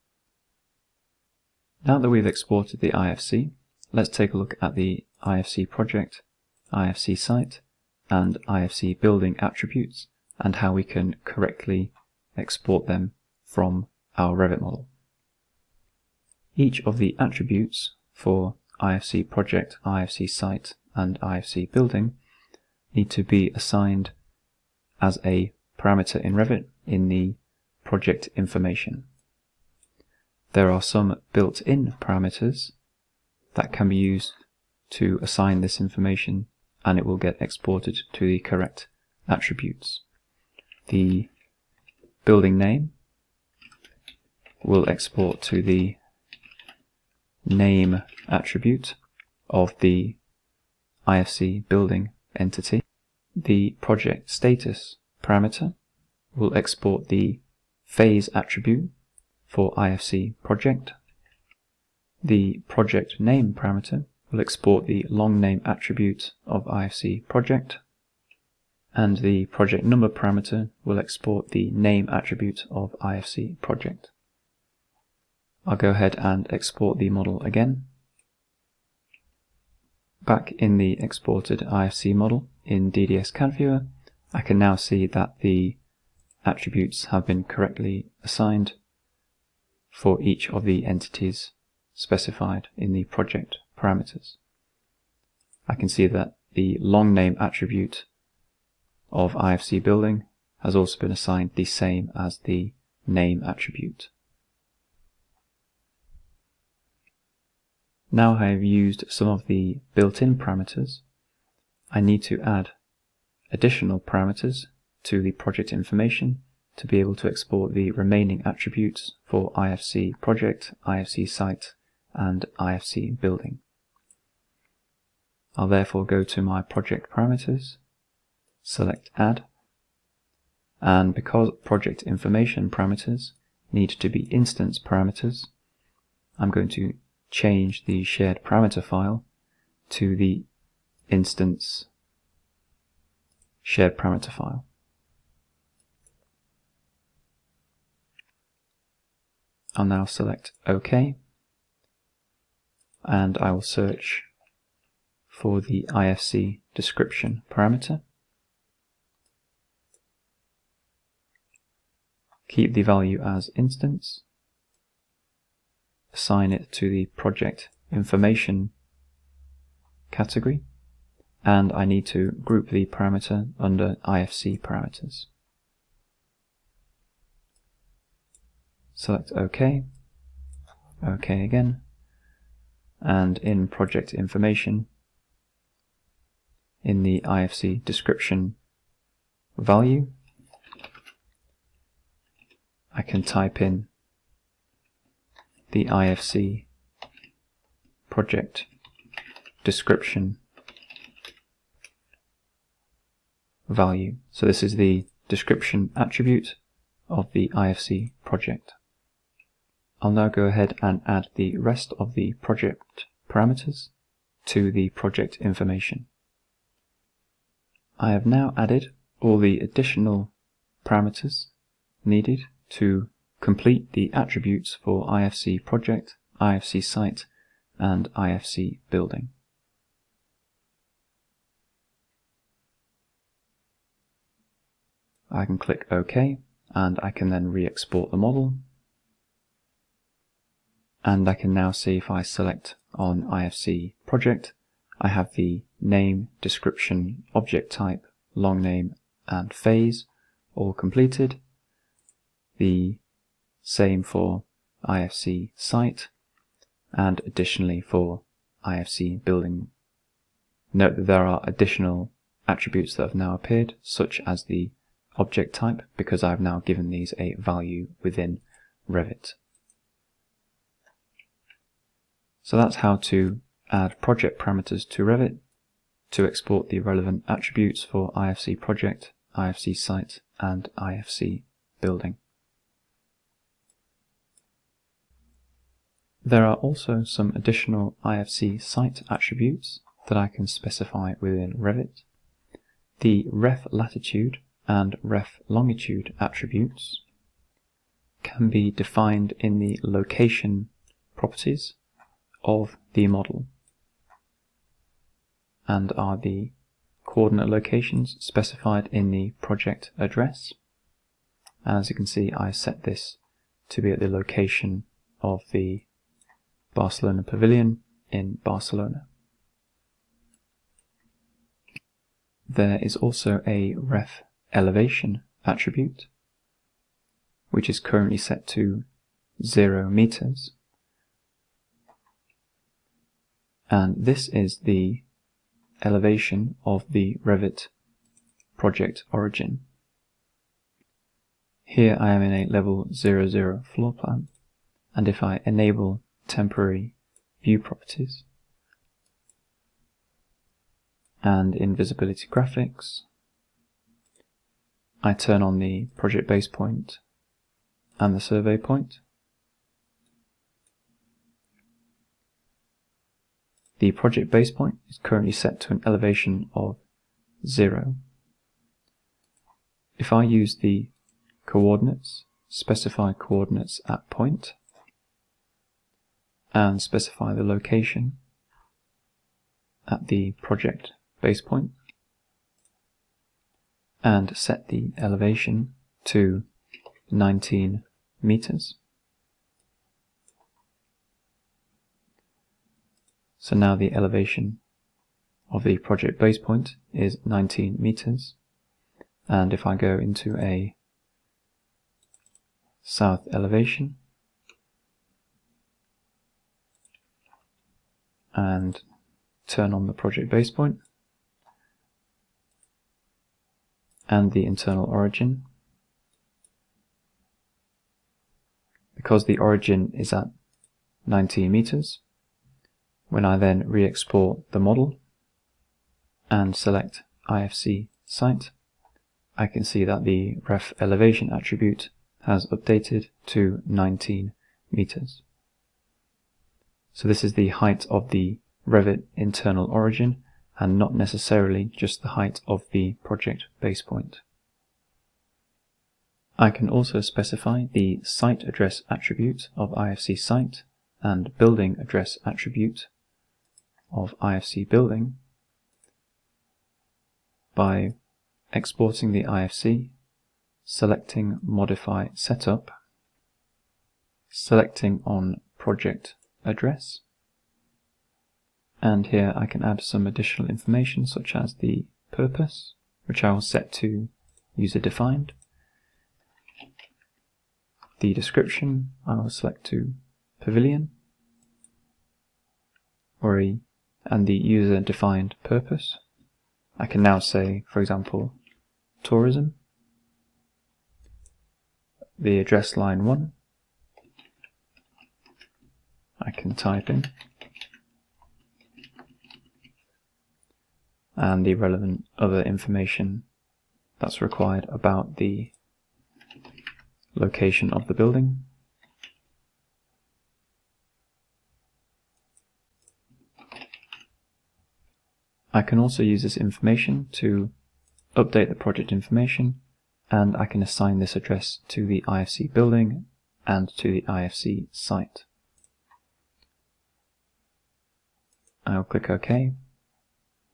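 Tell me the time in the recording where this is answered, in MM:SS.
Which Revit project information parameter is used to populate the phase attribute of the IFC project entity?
00:53.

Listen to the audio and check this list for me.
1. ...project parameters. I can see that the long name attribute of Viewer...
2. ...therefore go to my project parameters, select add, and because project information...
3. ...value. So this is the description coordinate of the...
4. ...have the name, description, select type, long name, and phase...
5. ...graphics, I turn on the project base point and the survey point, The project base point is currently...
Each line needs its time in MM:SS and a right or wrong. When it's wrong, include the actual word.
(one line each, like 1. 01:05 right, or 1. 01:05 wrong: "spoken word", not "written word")
1. 01:33 wrong: "IFC", not "Viewer"
2. 02:05 right
3. 03:23 wrong: "attribute", not "coordinate"
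4. 04:05 wrong: "object", not "select"
5. 05:52 right.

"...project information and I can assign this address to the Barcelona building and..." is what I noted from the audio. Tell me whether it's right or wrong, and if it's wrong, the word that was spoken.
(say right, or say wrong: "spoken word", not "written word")
wrong: "IFC", not "Barcelona".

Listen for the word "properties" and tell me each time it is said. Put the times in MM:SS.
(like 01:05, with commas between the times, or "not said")
05:01, 05:47.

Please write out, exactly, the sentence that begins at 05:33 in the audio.
and this is the elevation of the Revit project origin.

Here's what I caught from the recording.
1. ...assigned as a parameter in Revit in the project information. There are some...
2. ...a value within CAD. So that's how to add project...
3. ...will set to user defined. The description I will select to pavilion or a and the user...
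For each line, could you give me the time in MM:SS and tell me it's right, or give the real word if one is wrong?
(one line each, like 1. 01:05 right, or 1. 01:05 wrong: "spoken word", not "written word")
1. 00:23 right
2. 04:27 wrong: "Revit", not "CAD"
3. 07:53 right.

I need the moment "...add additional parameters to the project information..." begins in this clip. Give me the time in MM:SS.
01:52.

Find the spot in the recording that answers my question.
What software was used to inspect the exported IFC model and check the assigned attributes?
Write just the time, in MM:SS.
01:22.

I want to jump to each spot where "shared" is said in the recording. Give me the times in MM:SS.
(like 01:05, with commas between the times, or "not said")
02:18, 02:23.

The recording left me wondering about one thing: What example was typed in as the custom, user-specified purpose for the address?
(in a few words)
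Tourism.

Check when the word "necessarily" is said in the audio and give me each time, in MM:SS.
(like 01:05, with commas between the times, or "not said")
07:20.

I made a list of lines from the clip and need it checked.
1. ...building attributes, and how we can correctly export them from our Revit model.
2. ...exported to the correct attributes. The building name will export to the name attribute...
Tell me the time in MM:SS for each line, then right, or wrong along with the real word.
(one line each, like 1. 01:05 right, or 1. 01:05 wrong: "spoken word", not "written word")
1. 00:09 right
2. 00:37 right.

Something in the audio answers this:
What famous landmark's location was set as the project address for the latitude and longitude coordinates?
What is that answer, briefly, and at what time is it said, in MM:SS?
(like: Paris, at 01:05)
Barcelona Pavilion, at 05:16.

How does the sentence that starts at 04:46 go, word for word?
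There are also some additional IFC site attributes that I can specify within Revit.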